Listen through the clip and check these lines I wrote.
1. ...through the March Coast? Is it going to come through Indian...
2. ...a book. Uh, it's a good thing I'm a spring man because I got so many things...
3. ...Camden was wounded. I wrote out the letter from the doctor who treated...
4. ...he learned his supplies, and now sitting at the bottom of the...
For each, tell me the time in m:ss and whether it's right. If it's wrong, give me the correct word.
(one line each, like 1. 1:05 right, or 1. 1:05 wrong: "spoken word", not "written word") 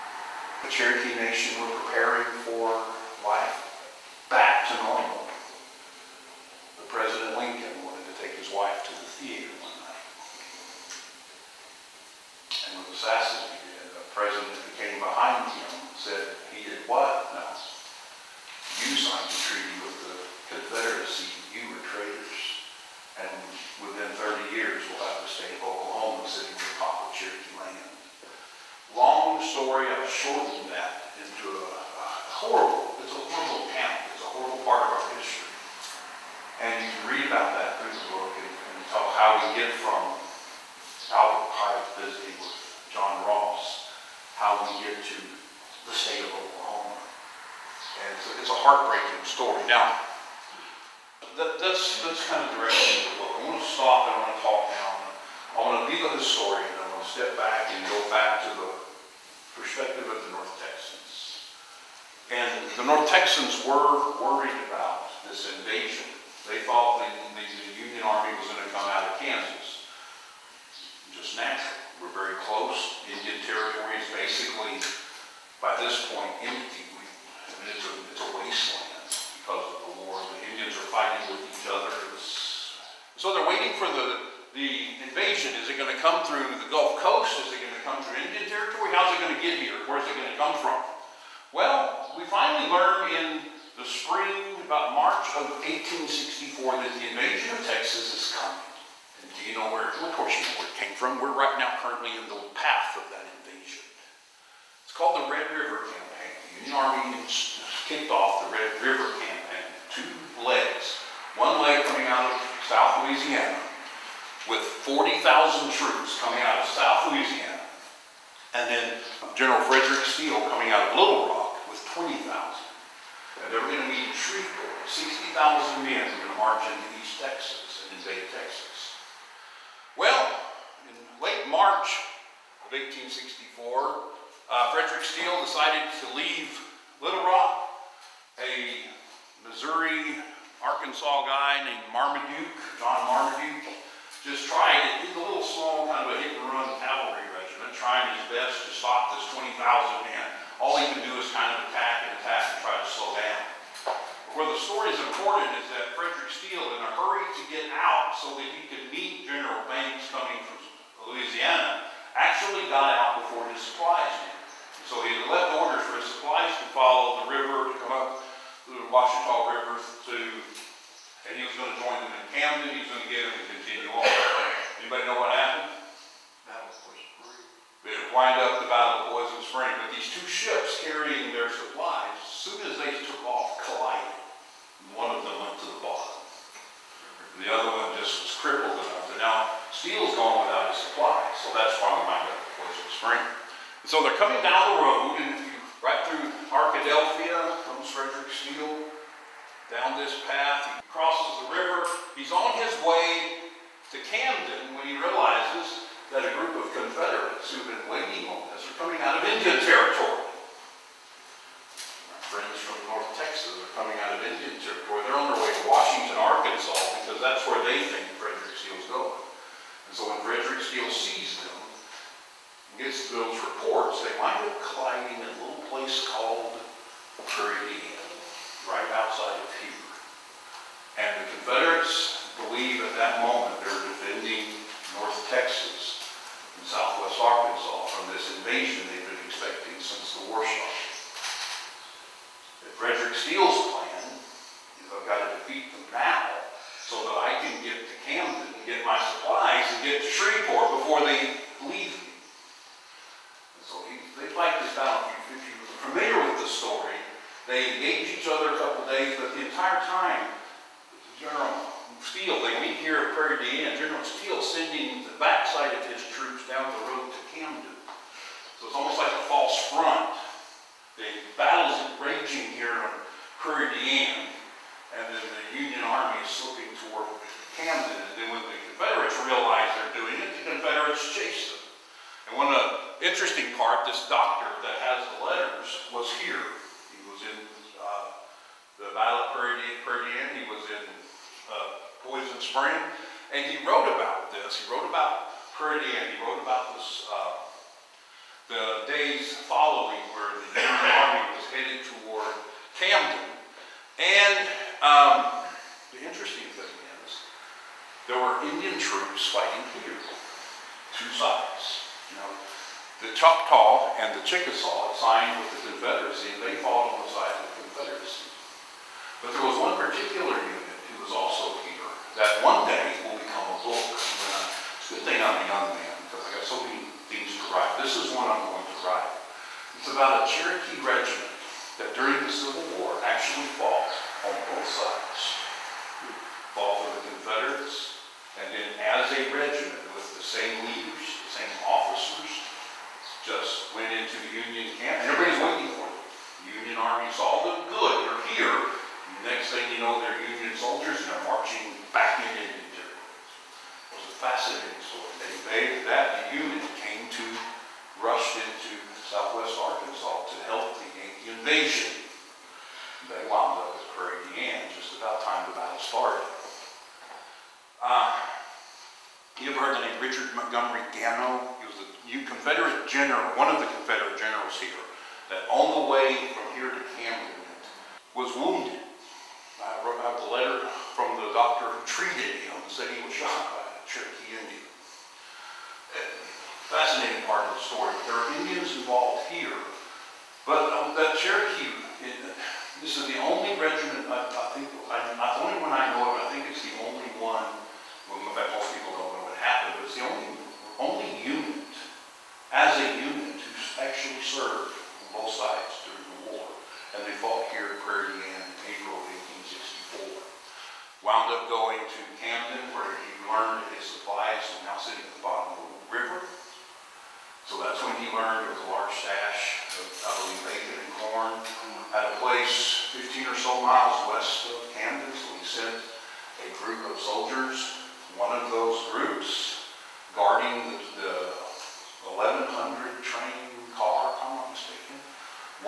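1. 1:26 wrong: "Gulf", not "March"
2. 5:23 wrong: "young", not "spring"
3. 6:16 right
4. 6:52 right.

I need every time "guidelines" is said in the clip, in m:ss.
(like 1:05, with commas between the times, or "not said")
not said.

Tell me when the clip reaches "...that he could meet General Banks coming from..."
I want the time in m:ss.
2:38.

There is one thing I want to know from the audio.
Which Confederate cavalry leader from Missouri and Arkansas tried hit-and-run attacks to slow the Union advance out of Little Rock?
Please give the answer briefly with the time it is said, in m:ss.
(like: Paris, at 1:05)
John Marmaduke, at 2:22.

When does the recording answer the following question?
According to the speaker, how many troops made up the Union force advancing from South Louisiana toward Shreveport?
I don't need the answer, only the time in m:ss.
1:54.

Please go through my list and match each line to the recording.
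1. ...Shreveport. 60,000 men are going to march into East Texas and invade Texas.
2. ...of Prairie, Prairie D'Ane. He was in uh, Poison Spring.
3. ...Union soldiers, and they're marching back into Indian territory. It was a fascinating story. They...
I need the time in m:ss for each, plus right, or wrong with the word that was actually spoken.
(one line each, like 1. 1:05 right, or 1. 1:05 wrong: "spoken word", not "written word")
1. 2:04 right
2. 4:49 right
3. 5:50 right.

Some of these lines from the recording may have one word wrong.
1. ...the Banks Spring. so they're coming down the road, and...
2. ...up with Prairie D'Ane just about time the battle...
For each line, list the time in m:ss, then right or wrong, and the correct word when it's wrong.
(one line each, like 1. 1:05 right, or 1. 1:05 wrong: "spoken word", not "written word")
1. 3:12 wrong: "Poison", not "Banks"
2. 6:03 right.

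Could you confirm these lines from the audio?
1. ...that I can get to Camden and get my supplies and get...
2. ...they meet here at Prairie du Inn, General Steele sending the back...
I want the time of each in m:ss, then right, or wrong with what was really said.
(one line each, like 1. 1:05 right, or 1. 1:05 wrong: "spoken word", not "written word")
1. 4:07 right
2. 4:22 right.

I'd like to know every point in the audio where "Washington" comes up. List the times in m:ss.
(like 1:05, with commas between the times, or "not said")
3:35.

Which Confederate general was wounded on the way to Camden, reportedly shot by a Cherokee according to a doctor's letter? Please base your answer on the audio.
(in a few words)
Richard Montgomery Gano.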